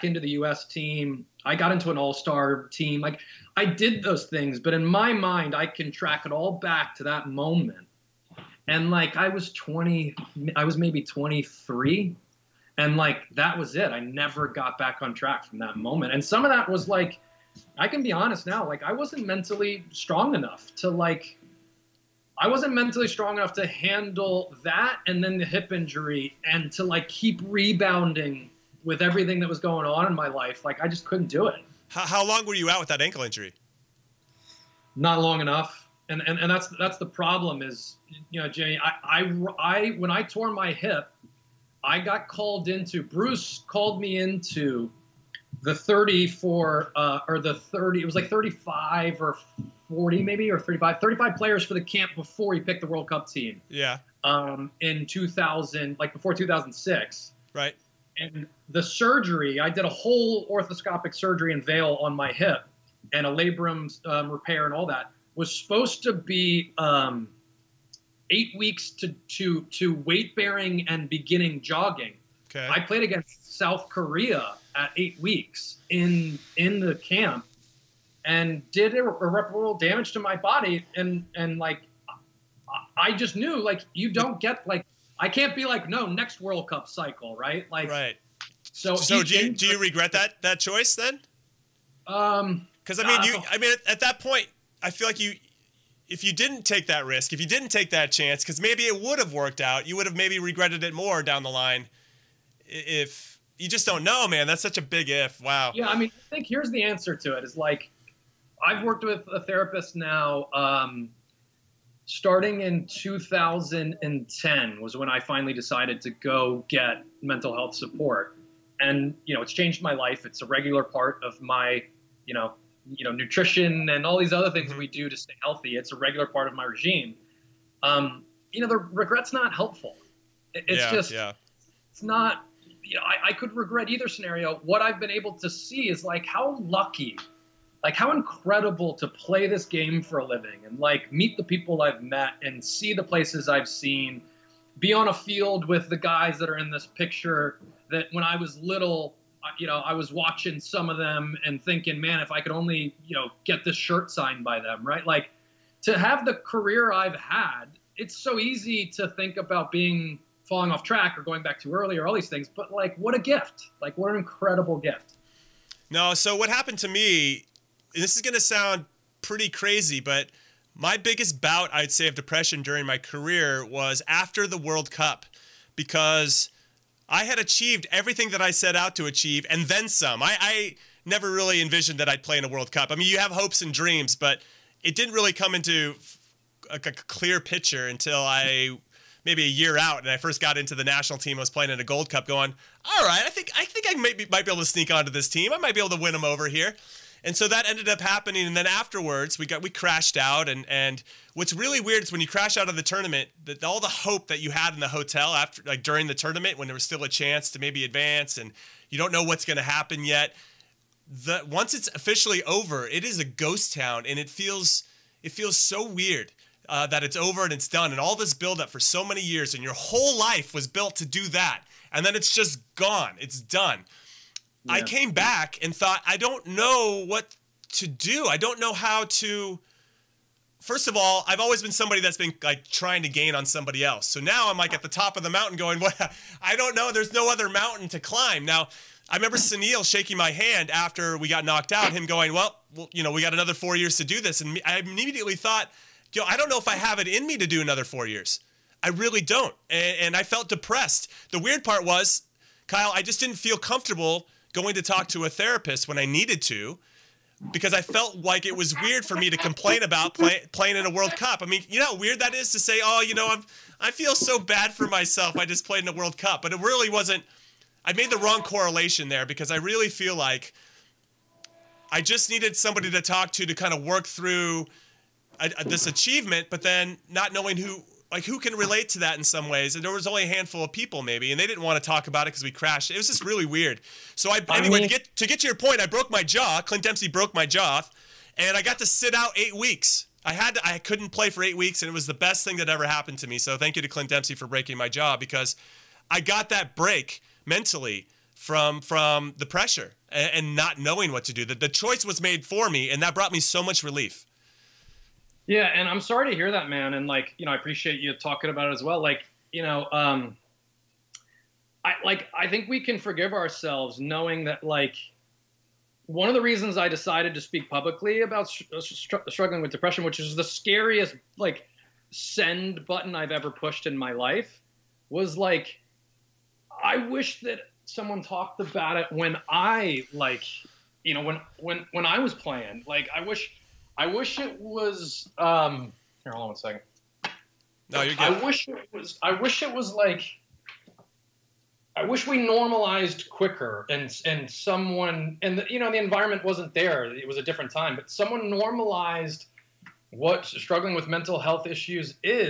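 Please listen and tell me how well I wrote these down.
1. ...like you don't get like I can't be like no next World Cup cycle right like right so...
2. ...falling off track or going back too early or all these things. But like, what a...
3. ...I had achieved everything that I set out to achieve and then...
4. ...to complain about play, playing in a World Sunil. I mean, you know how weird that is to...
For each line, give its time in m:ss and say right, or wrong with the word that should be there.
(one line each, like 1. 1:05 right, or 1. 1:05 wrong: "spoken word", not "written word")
1. 1:23 right
2. 2:40 right
3. 2:57 right
4. 4:19 wrong: "Cup", not "Sunil".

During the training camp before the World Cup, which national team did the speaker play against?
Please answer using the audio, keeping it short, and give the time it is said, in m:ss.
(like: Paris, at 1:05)
South Korea, at 1:13.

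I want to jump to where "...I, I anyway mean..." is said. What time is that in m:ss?
4:44.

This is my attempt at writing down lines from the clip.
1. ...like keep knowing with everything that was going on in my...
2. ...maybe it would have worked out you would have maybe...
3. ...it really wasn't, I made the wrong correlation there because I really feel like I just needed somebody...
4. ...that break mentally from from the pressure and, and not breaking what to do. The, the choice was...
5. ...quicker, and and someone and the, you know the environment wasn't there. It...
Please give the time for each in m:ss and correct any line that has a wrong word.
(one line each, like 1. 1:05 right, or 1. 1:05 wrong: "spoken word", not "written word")
1. 0:26 wrong: "rebounding", not "knowing"
2. 1:38 right
3. 4:26 right
4. 4:56 wrong: "knowing", not "breaking"
5. 5:43 right.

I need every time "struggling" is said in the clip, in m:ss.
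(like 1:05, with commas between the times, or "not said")
5:19, 5:50.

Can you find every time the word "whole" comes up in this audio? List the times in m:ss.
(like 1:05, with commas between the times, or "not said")
0:59, 3:39.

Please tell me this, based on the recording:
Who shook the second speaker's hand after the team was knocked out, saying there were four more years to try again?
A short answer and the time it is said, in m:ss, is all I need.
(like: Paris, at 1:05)
Sunil, at 3:59.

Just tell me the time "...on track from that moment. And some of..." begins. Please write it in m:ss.
0:15.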